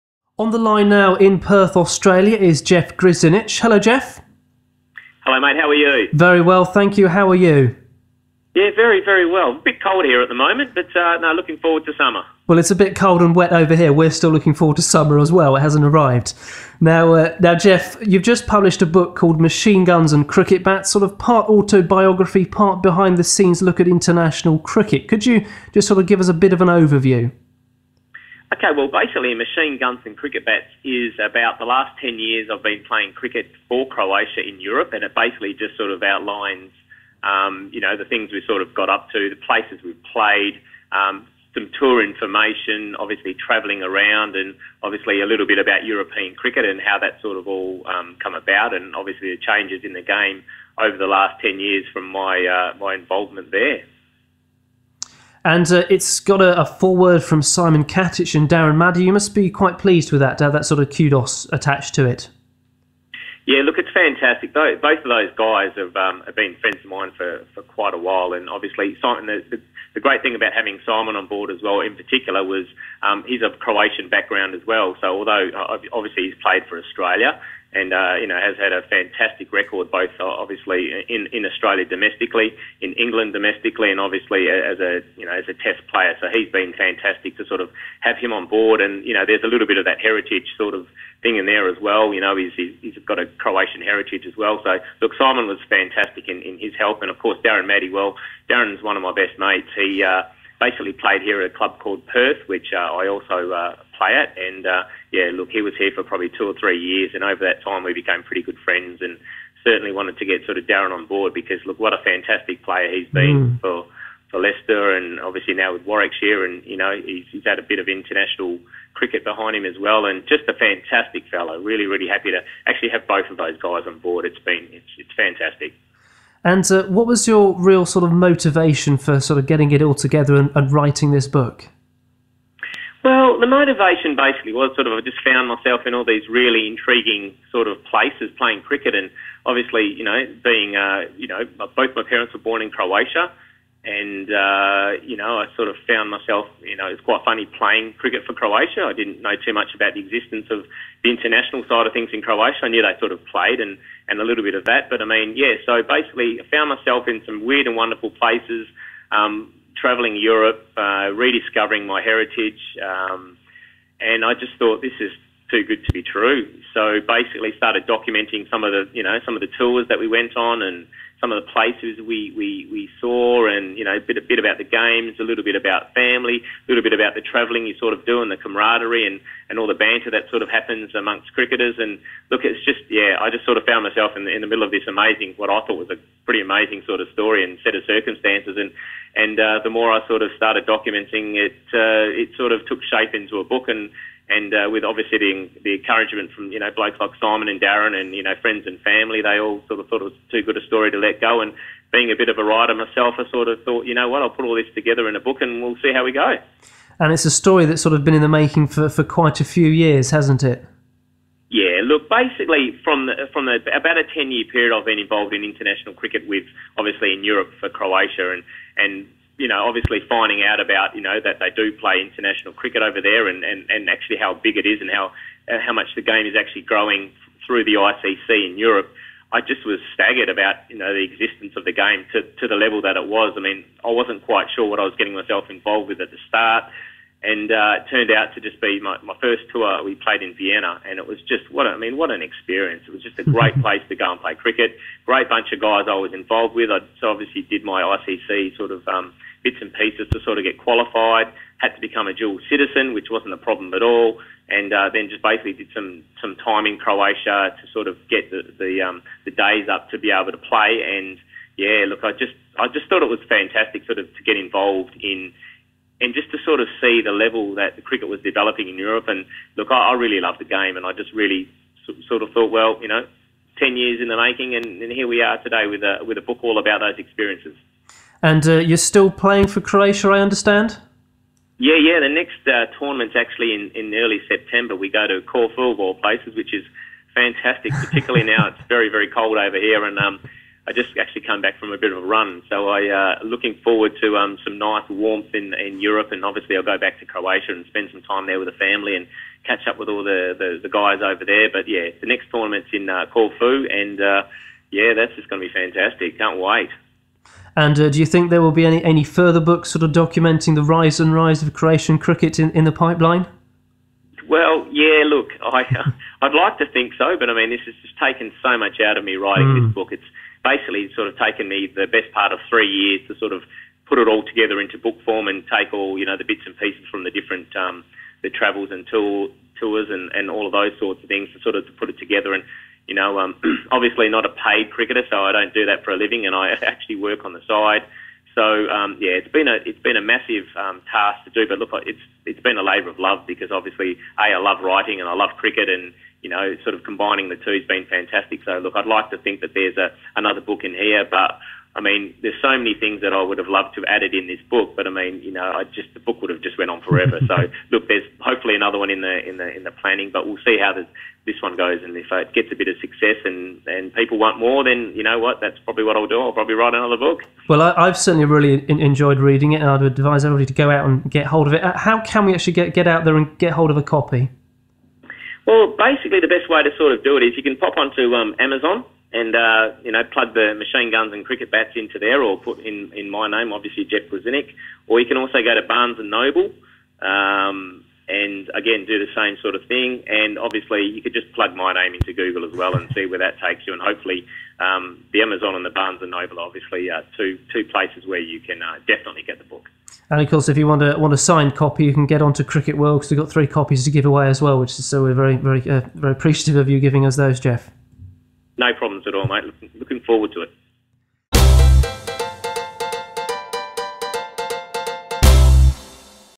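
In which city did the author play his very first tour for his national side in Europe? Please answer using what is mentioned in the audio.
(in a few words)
Vienna.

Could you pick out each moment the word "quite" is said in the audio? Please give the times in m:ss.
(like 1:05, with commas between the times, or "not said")
0:59, 1:07, 2:27, 3:29, 3:54.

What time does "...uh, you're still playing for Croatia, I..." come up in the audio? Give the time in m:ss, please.
4:38.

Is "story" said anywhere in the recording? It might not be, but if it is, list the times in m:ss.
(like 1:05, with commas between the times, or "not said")
3:07, 3:20, 3:27.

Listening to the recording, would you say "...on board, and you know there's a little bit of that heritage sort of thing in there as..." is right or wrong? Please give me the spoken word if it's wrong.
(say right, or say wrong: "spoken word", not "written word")
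right.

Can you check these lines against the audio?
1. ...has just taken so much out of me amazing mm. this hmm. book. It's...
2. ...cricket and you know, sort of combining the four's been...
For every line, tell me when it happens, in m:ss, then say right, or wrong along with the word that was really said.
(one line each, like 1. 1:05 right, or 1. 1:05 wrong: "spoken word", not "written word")
1. 5:17 wrong: "writing", not "amazing"
2. 5:45 wrong: "two", not "four".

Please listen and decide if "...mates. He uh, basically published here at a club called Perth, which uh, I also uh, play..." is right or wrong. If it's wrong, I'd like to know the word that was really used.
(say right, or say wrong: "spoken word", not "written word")
wrong: "played", not "published".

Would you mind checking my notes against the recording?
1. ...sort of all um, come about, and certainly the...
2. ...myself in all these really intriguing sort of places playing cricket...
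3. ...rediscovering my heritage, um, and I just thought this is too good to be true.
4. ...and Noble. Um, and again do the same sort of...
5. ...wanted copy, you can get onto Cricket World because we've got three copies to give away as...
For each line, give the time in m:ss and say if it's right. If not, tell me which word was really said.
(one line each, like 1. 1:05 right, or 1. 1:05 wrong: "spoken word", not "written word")
1. 0:47 wrong: "obviously", not "certainly"
2. 2:15 right
3. 2:41 right
4. 6:25 right
5. 6:41 wrong: "signed", not "wanted".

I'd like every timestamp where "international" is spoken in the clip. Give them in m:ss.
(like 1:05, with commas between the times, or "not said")
0:23, 1:57, 2:31, 3:35, 3:41.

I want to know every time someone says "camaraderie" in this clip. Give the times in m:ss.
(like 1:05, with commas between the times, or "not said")
2:58.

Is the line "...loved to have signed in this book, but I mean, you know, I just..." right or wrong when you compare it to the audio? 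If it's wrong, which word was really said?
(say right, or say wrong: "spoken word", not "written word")
wrong: "added", not "signed".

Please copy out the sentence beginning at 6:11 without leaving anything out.
Uh, how can we actually get get out there and get hold of a copy?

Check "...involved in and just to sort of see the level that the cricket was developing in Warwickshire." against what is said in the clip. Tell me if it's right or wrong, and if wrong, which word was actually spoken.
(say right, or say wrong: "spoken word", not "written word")
wrong: "Europe", not "Warwickshire".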